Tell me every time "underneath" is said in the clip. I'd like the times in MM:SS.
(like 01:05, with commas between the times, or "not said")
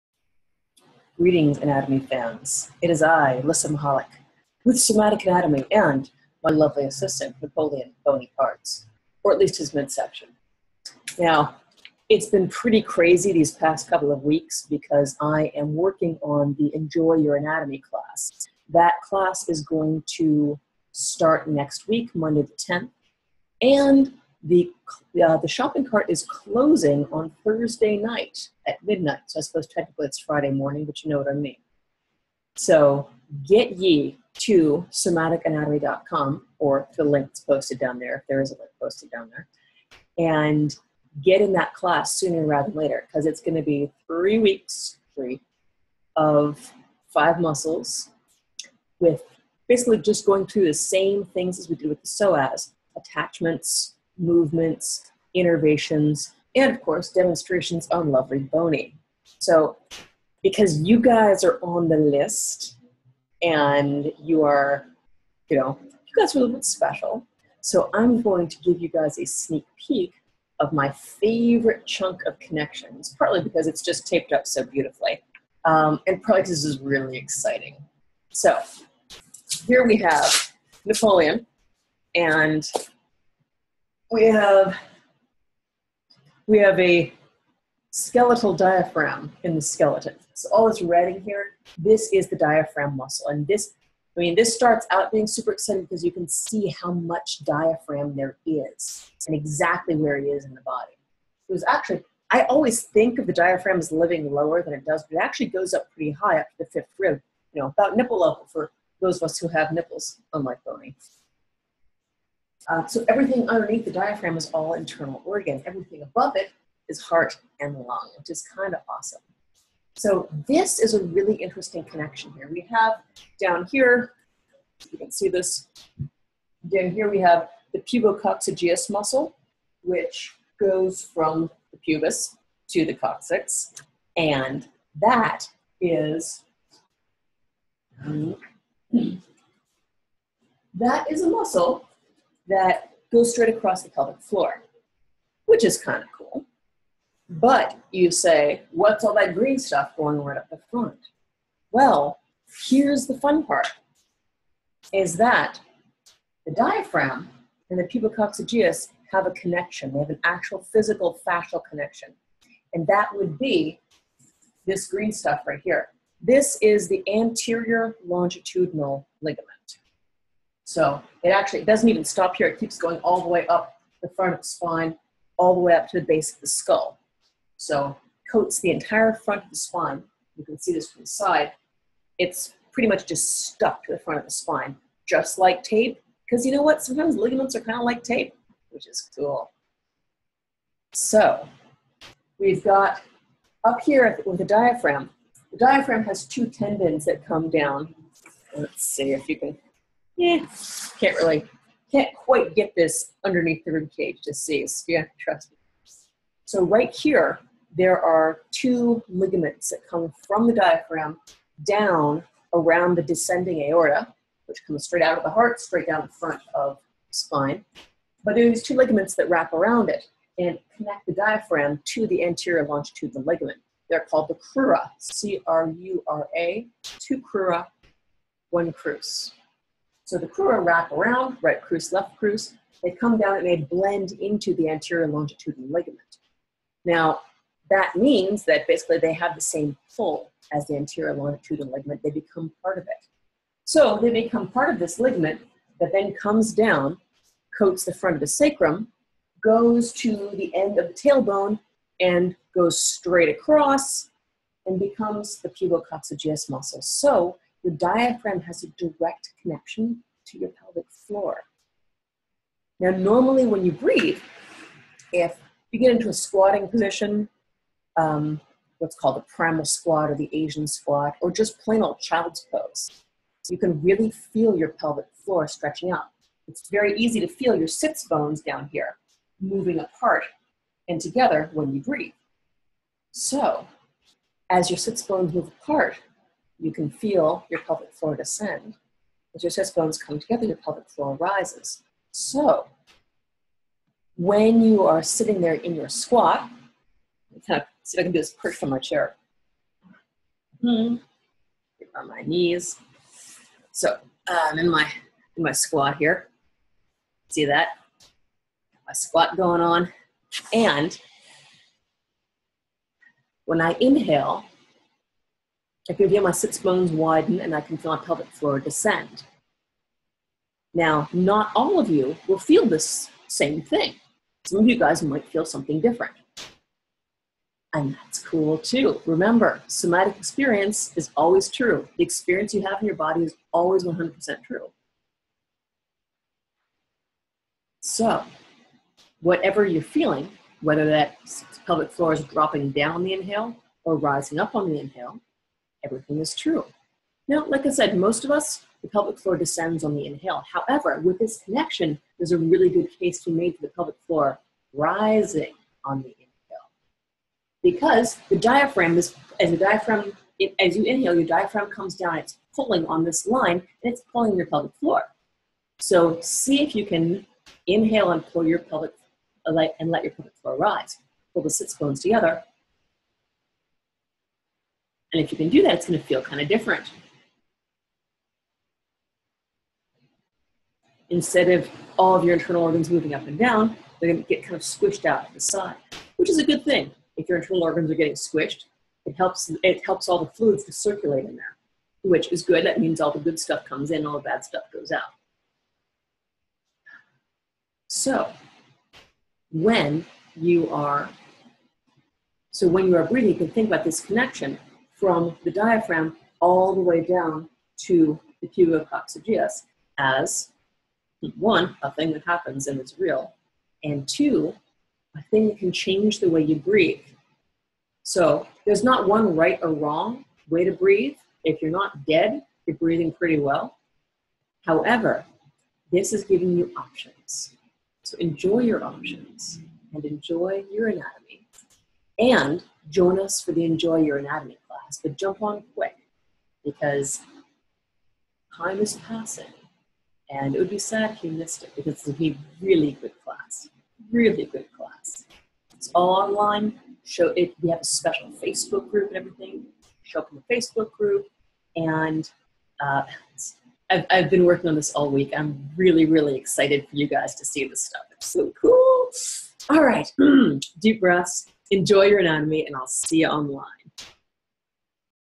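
01:53, 03:23.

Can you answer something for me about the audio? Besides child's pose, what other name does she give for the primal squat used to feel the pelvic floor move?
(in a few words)
Asian squat.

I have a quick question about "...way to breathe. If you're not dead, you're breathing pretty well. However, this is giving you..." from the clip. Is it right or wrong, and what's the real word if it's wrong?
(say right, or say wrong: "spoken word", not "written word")
right.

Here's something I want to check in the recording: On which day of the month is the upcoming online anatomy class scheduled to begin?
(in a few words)
10th.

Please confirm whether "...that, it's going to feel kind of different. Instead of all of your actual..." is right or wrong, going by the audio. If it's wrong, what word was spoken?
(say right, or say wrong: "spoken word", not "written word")
wrong: "internal", not "actual".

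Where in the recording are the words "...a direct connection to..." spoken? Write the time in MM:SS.
04:18.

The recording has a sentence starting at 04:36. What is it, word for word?
It's very easy to feel your sits bones down here moving apart and together when you breathe.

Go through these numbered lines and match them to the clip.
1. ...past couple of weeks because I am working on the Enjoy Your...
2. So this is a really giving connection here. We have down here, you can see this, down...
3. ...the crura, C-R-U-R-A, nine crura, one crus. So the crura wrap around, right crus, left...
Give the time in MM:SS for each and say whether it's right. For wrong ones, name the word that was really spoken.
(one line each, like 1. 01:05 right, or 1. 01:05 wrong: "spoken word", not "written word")
1. 00:13 right
2. 01:59 wrong: "interesting", not "giving"
3. 03:44 wrong: "two", not "nine".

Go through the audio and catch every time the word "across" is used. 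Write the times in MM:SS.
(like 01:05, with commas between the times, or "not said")
02:23, 04:13.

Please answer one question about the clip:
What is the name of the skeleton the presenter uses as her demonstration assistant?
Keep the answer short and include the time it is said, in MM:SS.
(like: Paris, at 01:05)
Napoleon Bony Parts, at 00:07.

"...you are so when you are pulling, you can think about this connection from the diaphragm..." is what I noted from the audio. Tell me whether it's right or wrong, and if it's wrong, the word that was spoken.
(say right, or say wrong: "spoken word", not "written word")
wrong: "breathing", not "pulling".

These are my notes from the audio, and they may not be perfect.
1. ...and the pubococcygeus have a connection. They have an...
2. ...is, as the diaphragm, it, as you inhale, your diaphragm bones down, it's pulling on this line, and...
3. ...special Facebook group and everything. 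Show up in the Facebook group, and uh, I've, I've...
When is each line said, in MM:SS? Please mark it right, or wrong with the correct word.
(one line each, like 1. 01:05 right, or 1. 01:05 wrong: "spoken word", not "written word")
1. 02:37 right
2. 05:58 wrong: "comes", not "bones"
3. 07:27 right.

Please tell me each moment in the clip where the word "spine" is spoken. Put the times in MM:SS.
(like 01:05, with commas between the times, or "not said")
02:54, 02:59, 03:04, 03:37.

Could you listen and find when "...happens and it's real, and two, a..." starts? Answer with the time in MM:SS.
06:52.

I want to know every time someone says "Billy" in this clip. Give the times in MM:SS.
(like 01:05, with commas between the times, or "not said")
not said.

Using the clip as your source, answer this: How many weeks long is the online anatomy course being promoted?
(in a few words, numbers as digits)
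3.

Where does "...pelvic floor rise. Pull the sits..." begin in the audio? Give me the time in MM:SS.
06:10.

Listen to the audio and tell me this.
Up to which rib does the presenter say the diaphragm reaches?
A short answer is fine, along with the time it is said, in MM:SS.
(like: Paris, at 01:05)
5th rib, at 01:46.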